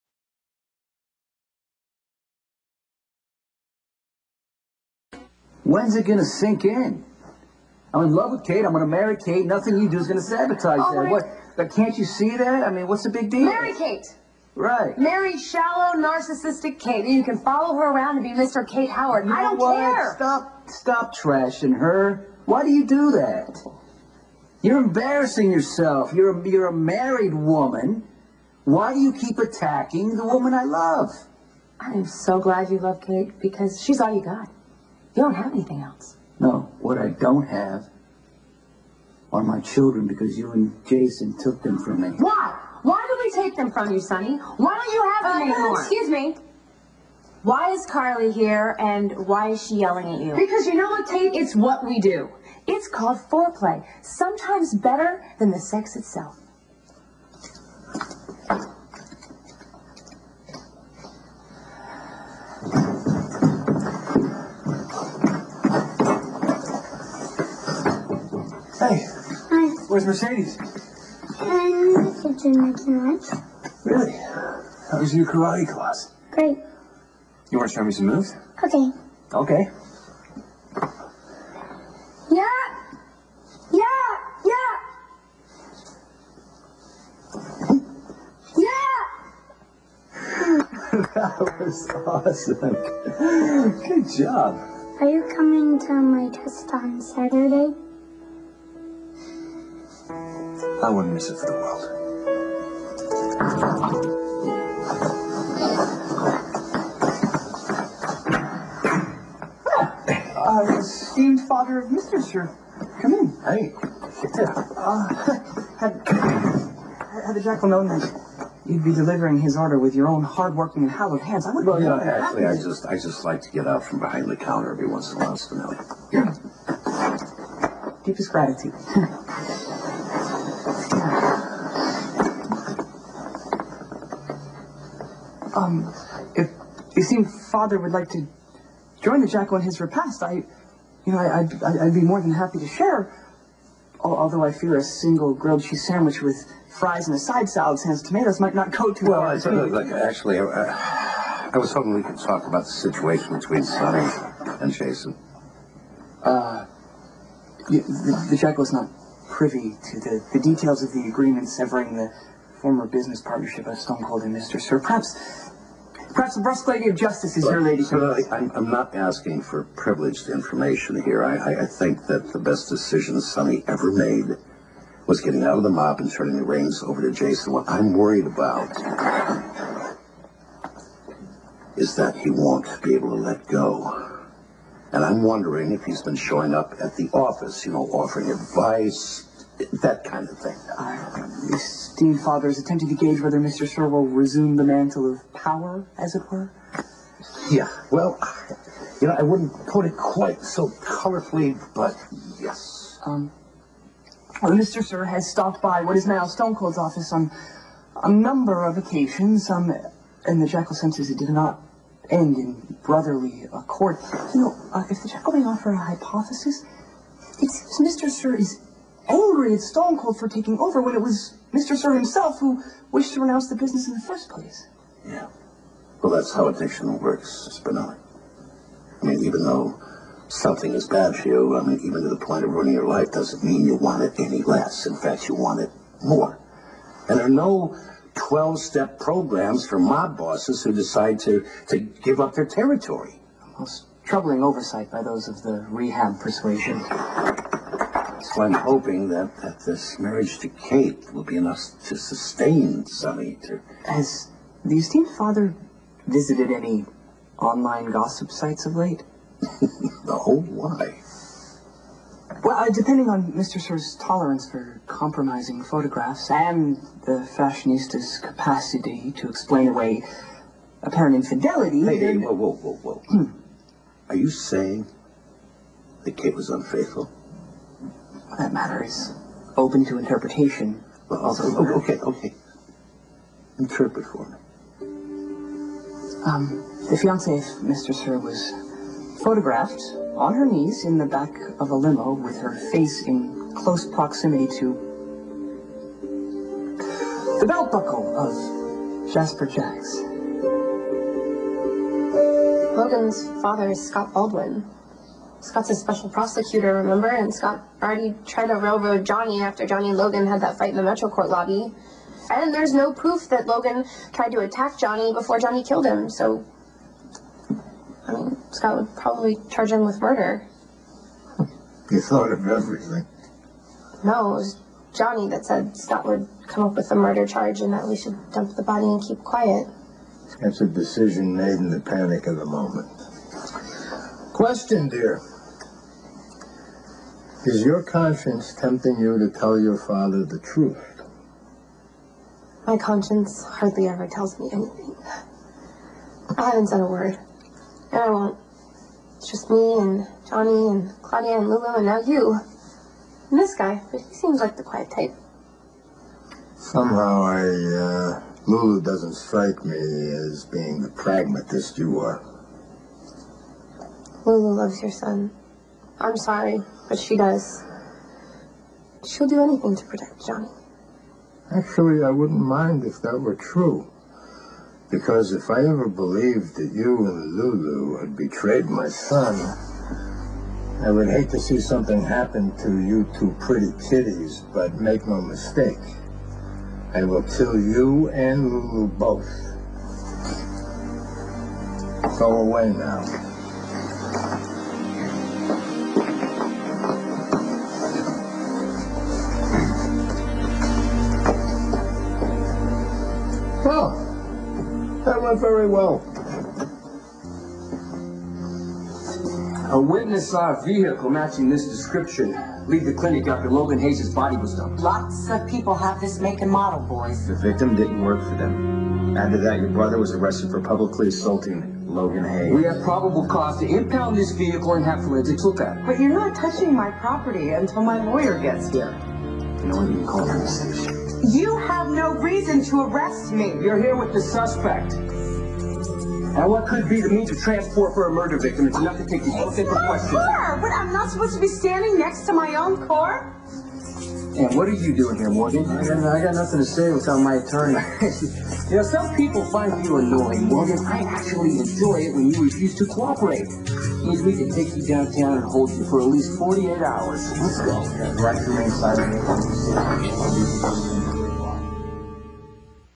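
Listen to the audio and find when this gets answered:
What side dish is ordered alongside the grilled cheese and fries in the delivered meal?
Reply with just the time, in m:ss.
2:27.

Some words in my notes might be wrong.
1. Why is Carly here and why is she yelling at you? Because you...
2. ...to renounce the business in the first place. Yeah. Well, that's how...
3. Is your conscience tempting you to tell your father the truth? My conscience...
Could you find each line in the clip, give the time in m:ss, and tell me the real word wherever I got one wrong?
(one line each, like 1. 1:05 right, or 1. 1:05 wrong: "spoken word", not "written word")
1. 0:47 right
2. 3:43 right
3. 5:37 right.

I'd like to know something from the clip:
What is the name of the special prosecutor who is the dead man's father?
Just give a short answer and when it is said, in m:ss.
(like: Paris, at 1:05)
Scott Baldwin, at 5:03.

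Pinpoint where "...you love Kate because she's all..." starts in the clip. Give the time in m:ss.
0:32.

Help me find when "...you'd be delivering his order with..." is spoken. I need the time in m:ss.
1:58.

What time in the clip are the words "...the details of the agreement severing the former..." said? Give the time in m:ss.
2:40.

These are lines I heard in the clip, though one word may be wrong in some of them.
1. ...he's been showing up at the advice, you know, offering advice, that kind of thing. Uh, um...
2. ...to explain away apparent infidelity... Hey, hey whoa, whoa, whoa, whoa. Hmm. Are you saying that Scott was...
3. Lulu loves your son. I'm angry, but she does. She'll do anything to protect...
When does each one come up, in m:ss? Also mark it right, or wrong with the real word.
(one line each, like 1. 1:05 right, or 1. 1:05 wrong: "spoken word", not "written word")
1. 3:05 wrong: "office", not "advice"
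2. 4:29 wrong: "Kate", not "Scott"
3. 6:04 wrong: "sorry", not "angry".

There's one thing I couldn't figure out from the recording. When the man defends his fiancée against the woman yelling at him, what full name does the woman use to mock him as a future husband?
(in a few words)
Mr. Kate Howard.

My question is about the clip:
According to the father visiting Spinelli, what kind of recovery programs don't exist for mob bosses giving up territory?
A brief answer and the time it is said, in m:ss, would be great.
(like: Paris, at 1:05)
12 step programs, at 3:58.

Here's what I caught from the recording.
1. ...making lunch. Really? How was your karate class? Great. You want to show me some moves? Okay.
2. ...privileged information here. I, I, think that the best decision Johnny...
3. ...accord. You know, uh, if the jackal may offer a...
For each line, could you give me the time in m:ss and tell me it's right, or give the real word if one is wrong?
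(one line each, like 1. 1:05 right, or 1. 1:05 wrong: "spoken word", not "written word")
1. 1:12 right
2. 2:49 wrong: "Sonny", not "Johnny"
3. 3:33 right.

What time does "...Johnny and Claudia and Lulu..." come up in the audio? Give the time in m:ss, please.
5:50.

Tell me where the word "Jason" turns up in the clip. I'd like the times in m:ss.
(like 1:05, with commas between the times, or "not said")
0:40, 2:34, 2:57.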